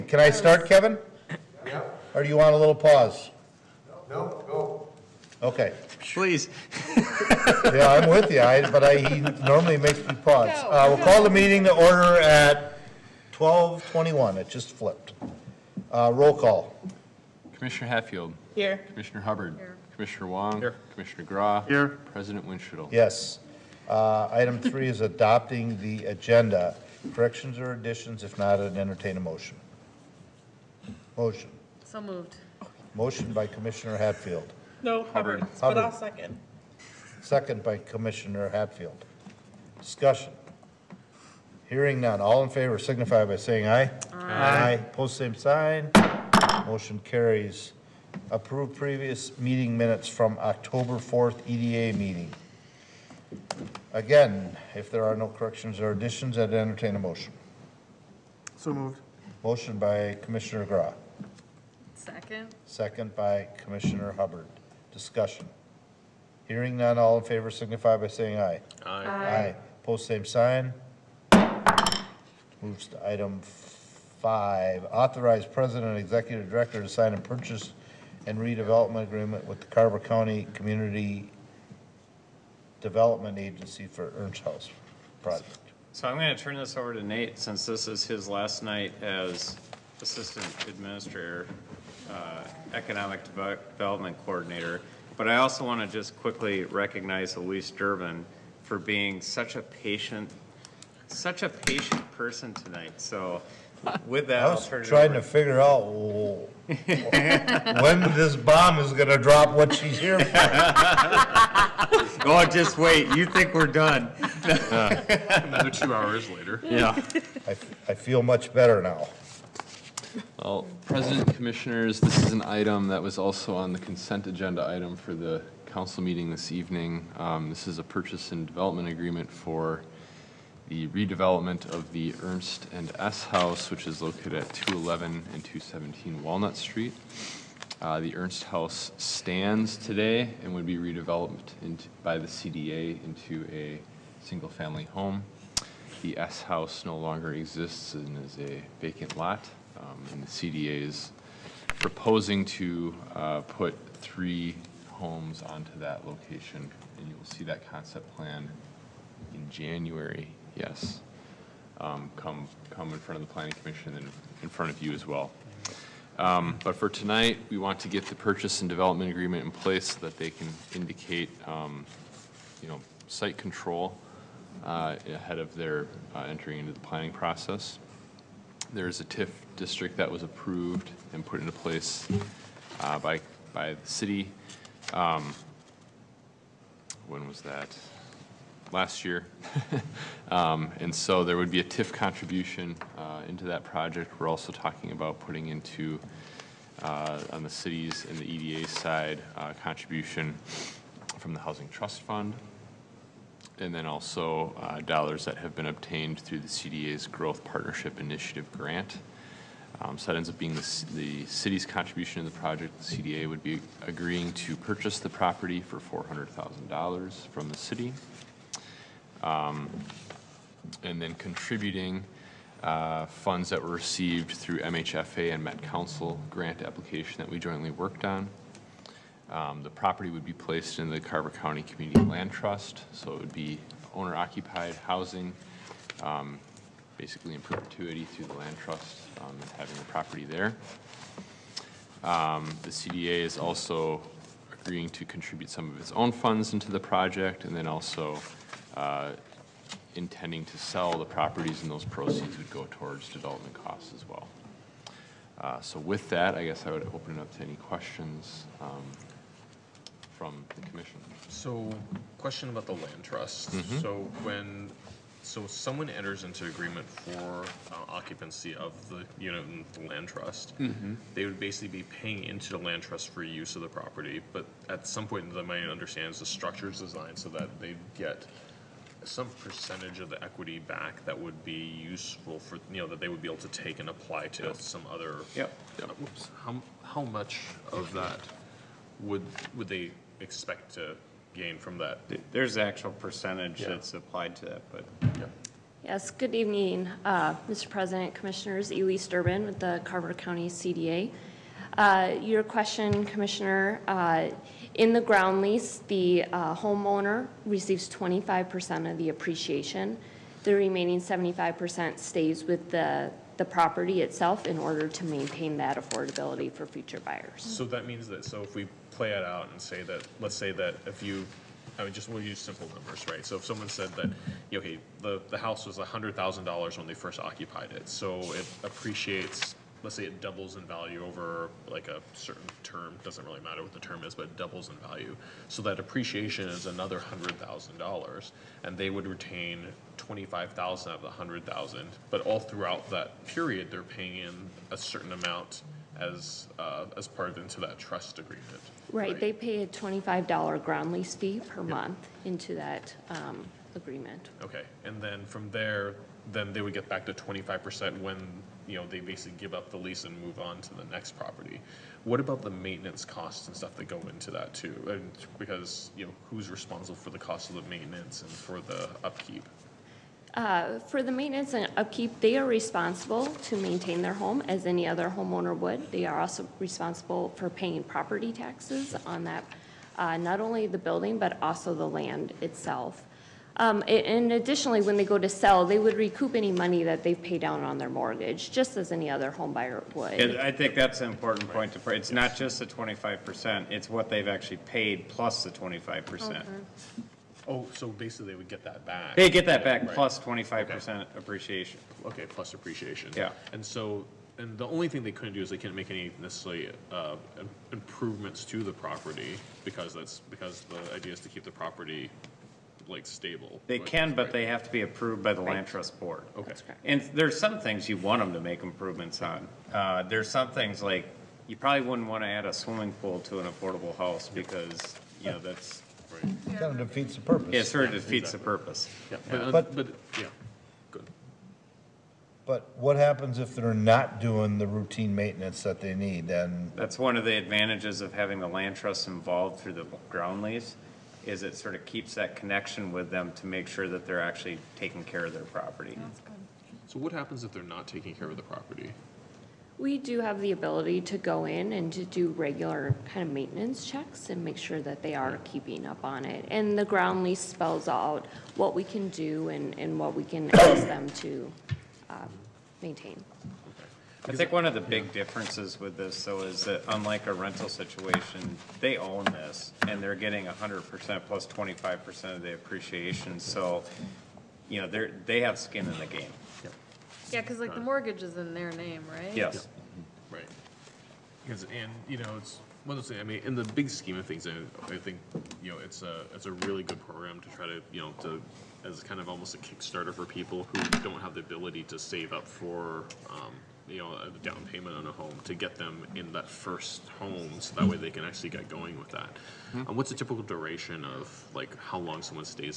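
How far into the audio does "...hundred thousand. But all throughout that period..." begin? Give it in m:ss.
5:41.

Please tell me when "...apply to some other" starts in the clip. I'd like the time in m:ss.
4:43.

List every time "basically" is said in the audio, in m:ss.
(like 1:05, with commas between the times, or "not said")
3:56, 4:31, 5:58, 6:37.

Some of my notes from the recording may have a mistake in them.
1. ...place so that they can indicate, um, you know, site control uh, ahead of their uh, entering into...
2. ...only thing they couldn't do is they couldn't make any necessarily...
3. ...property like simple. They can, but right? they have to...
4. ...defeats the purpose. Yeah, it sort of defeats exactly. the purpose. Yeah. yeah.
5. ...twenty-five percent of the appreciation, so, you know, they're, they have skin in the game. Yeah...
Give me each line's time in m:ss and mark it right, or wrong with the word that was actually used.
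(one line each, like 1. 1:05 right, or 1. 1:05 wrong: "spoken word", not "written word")
1. 2:49 right
2. 6:44 right
3. 6:51 wrong: "stable", not "simple"
4. 7:06 right
5. 7:51 right.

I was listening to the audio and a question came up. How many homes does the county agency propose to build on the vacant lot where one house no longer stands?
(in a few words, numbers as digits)
3.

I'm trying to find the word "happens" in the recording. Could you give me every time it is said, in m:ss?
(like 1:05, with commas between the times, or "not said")
7:12, 7:27.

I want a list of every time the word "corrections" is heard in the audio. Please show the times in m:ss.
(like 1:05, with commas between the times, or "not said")
0:27, 0:55.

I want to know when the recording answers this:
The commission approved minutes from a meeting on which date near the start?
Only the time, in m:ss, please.
0:50.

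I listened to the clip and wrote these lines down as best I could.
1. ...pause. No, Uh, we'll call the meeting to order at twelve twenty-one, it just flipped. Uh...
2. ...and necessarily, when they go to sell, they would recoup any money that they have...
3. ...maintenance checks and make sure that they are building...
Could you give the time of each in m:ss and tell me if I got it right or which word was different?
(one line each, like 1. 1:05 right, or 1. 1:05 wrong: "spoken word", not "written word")
1. 0:10 right
2. 6:23 wrong: "additionally", not "necessarily"
3. 7:33 wrong: "keeping", not "building".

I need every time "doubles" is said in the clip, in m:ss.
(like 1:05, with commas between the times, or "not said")
5:30, 5:34.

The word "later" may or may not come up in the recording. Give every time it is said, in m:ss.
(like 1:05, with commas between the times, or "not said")
1:56.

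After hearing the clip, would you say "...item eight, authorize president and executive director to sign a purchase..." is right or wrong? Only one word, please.
wrong.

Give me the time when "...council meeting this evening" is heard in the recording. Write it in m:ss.
2:05.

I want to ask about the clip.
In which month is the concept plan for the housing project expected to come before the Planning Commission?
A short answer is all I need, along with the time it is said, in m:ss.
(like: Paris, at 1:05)
January, at 2:39.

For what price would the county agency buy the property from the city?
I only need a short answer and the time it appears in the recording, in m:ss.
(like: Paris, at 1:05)
$400,000, at 3:35.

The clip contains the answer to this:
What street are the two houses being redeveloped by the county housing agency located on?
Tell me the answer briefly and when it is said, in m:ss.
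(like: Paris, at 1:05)
Walnut Street, at 2:16.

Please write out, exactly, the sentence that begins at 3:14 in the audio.
We're also talking about putting into, uh, on the city's and the EDA side, uh, contribution from the Housing Trust Fund.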